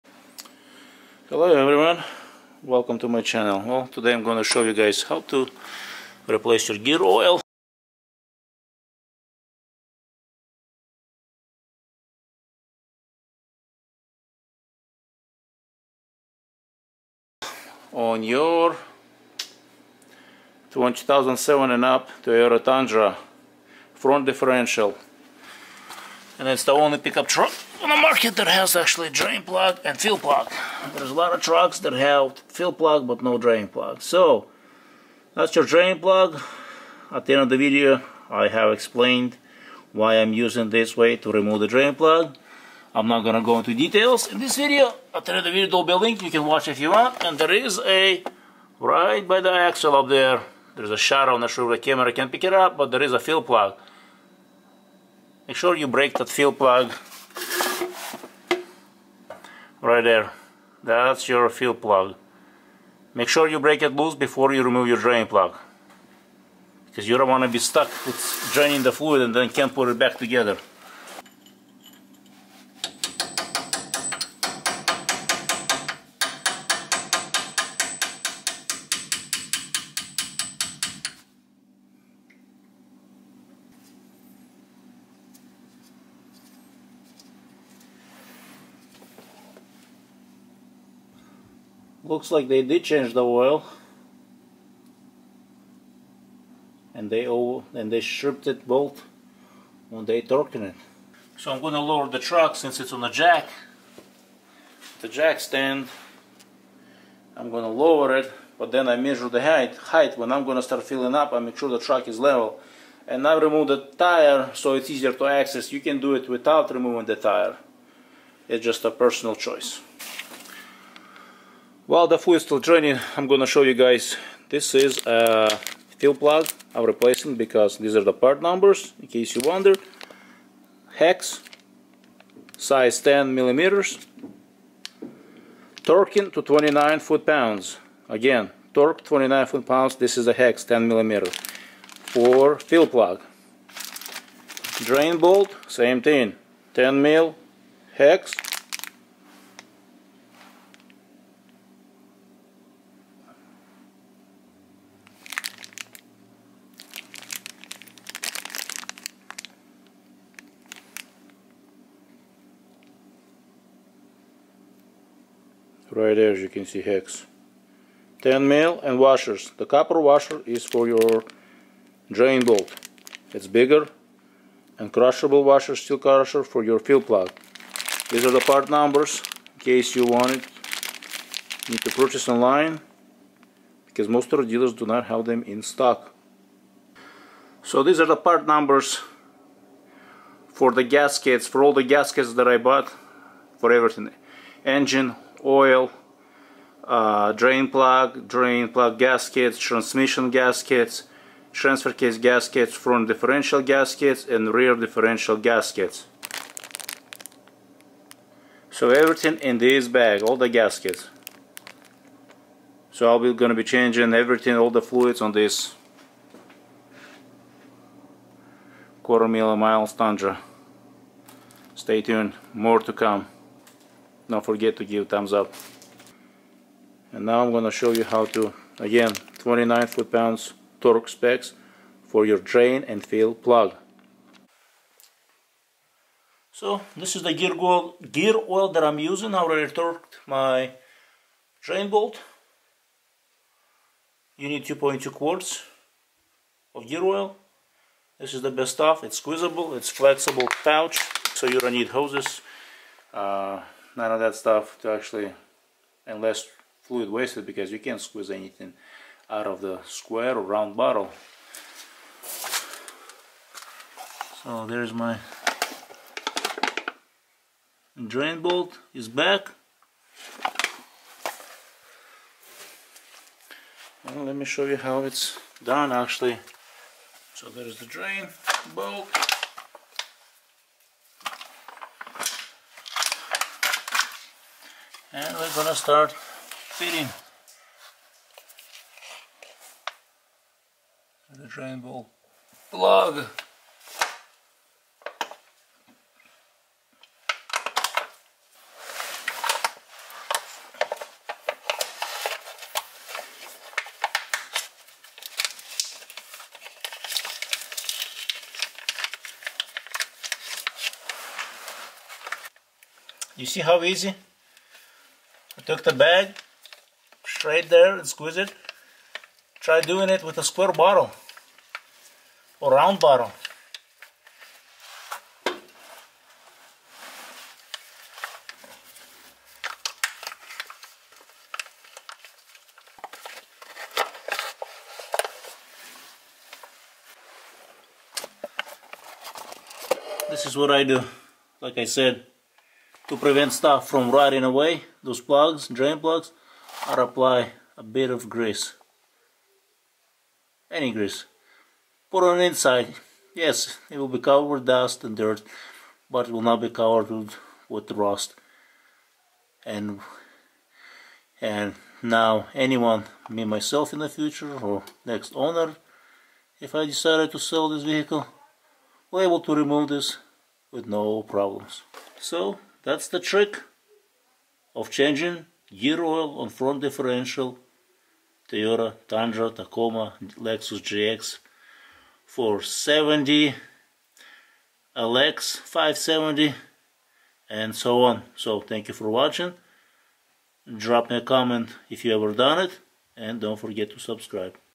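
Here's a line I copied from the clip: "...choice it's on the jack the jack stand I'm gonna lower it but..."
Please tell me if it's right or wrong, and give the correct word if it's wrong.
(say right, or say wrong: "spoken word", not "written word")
wrong: "since", not "choice".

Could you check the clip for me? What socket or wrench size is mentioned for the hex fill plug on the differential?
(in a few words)
10 millimeters.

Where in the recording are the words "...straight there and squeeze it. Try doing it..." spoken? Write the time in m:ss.
5:17.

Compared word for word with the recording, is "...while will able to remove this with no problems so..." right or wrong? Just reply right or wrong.
wrong.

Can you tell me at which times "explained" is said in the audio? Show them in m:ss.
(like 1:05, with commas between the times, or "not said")
0:38.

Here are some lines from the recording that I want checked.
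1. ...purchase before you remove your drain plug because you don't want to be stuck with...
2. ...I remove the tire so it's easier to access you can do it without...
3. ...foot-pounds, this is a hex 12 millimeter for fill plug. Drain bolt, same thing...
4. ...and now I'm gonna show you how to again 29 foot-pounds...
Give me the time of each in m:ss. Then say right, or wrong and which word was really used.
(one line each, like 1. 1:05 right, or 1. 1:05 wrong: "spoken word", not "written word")
1. 1:03 wrong: "loose", not "purchase"
2. 1:53 right
3. 2:19 wrong: "10", not "12"
4. 3:47 right.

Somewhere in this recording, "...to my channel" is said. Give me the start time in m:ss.
0:02.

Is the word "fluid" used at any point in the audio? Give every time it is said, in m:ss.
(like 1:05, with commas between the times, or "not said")
1:08, 3:34, 4:16.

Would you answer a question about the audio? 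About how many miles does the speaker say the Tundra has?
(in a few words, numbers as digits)
Quarter million miles.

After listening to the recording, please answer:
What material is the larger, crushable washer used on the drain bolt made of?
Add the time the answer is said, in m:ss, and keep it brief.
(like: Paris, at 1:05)
Copper, at 2:49.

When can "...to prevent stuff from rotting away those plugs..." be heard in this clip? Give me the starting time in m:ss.
5:43.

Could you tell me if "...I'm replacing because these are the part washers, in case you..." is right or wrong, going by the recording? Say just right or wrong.
wrong.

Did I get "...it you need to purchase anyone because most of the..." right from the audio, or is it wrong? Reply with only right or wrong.
wrong.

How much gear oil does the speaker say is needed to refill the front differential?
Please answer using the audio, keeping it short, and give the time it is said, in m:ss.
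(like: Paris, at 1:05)
2.2 quarts, at 4:04.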